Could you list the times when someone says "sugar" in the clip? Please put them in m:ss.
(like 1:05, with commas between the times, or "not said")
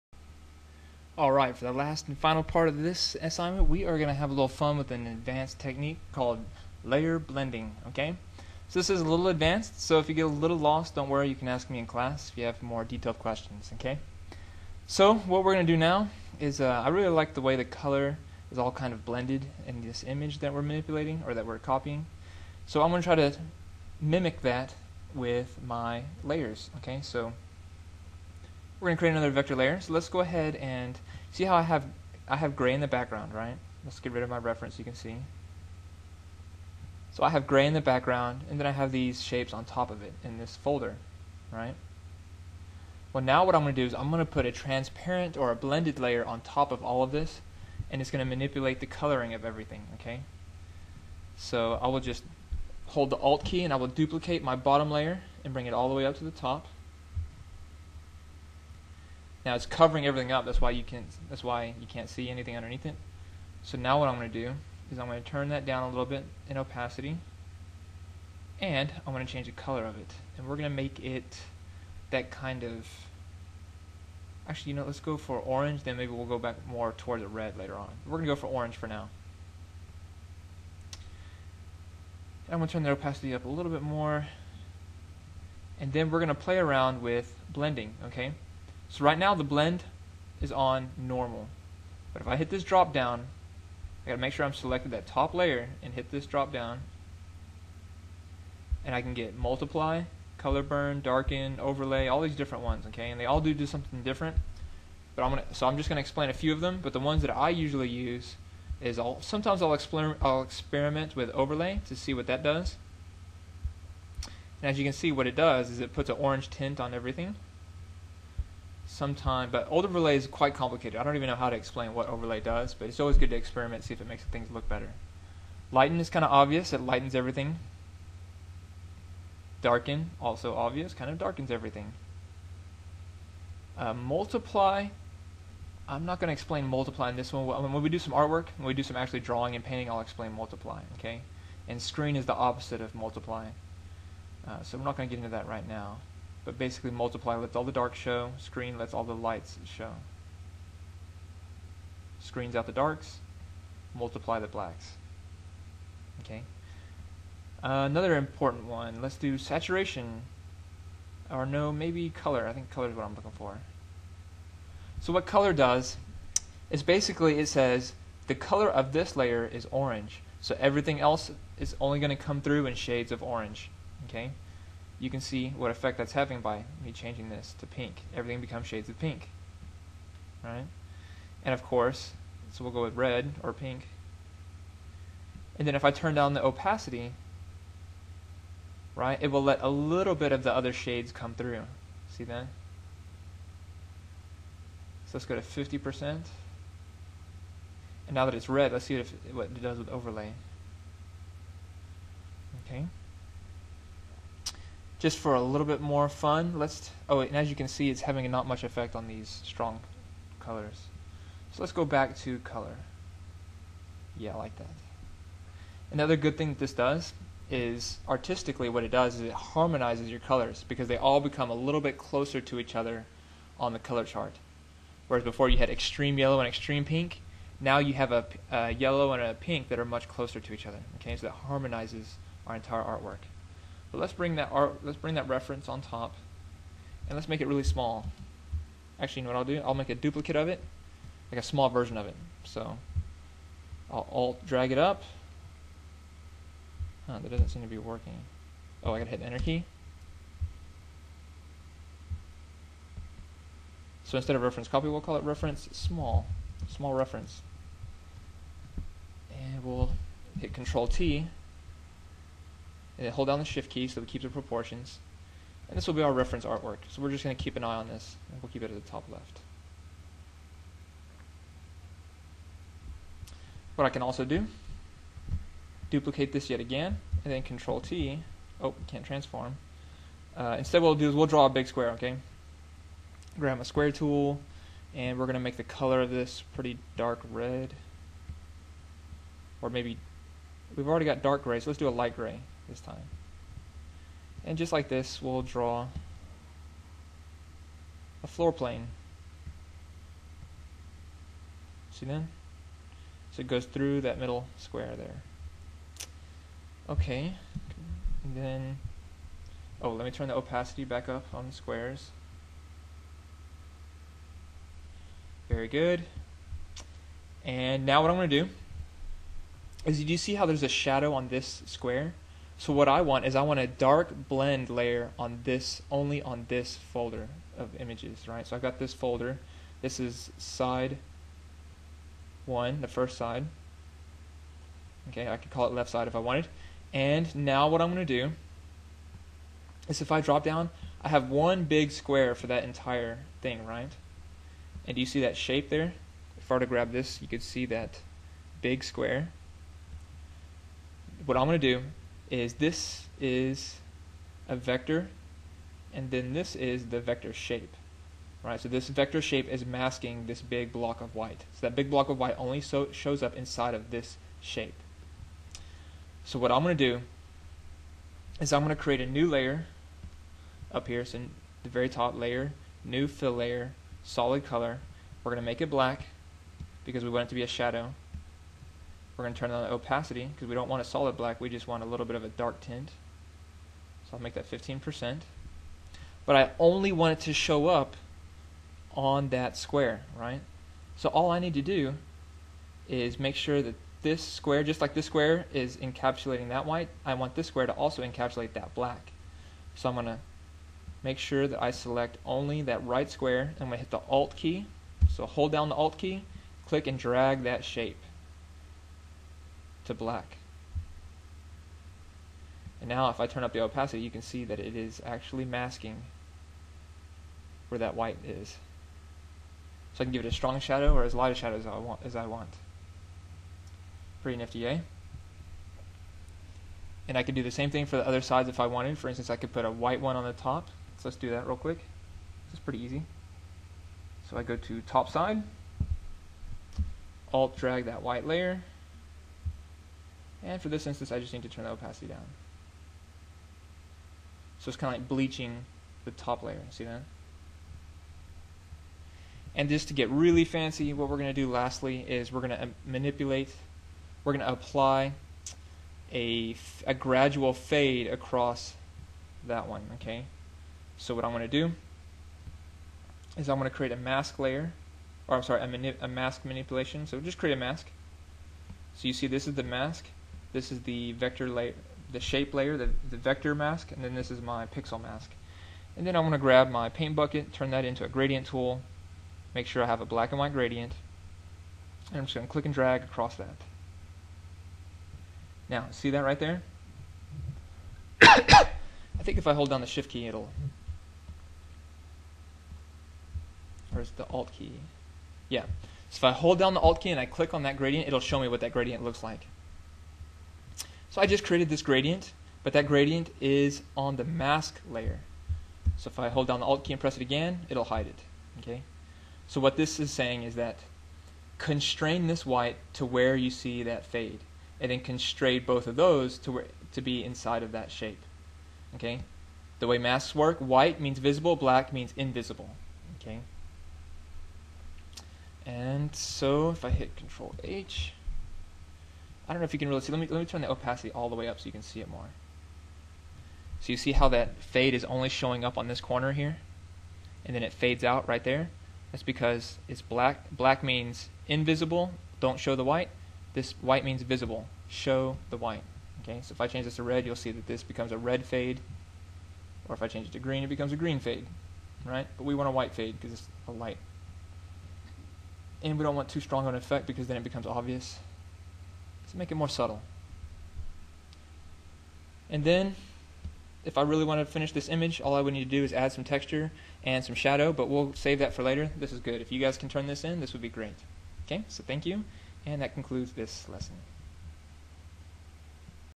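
not said.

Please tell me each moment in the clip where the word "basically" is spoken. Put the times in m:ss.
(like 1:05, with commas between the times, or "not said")
2:26, 2:46.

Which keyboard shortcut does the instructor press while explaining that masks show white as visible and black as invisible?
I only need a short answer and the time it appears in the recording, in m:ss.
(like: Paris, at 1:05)
Control H, at 8:47.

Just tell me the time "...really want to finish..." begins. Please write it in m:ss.
9:24.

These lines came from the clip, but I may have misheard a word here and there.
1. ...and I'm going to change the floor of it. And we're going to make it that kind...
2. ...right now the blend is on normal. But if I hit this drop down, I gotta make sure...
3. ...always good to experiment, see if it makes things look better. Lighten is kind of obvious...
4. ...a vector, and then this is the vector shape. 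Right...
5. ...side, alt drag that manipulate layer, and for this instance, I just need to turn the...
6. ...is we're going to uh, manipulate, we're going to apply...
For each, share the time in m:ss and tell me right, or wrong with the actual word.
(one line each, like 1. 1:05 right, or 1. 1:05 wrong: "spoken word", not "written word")
1. 1:08 wrong: "color", not "floor"
2. 1:29 right
3. 2:02 right
4. 5:54 right
5. 7:15 wrong: "white", not "manipulate"
6. 7:32 right.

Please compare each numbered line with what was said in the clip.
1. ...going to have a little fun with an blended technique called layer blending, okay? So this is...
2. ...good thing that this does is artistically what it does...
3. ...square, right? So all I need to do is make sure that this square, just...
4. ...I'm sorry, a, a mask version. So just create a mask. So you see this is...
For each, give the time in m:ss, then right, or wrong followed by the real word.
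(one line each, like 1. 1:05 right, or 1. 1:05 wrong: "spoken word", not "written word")
1. 0:03 wrong: "advanced", not "blended"
2. 3:36 right
3. 6:29 right
4. 7:45 wrong: "manipulation", not "version".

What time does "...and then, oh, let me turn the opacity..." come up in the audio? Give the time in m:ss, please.
5:08.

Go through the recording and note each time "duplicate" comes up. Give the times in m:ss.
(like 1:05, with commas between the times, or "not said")
0:53, 3:59, 4:35.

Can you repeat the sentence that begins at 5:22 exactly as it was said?
So what I want is I want a dark blend layer on this, only on this folder of images, right?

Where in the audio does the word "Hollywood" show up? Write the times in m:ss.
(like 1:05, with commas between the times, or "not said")
not said.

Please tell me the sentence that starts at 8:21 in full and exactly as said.
So I just created this gradient, but that gradient is on the mask layer.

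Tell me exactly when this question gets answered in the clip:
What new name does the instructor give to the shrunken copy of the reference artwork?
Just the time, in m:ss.
4:16.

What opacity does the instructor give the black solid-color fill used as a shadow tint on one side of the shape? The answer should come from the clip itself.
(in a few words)
15%.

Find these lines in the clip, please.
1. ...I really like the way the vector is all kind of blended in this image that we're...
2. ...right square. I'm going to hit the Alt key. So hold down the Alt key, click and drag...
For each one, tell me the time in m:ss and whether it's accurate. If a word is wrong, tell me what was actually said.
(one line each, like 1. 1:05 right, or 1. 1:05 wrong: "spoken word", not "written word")
1. 0:16 wrong: "color", not "vector"
2. 6:42 right.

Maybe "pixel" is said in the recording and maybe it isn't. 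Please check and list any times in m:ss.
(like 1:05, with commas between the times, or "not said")
7:54.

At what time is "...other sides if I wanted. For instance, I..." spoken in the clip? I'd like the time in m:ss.
7:08.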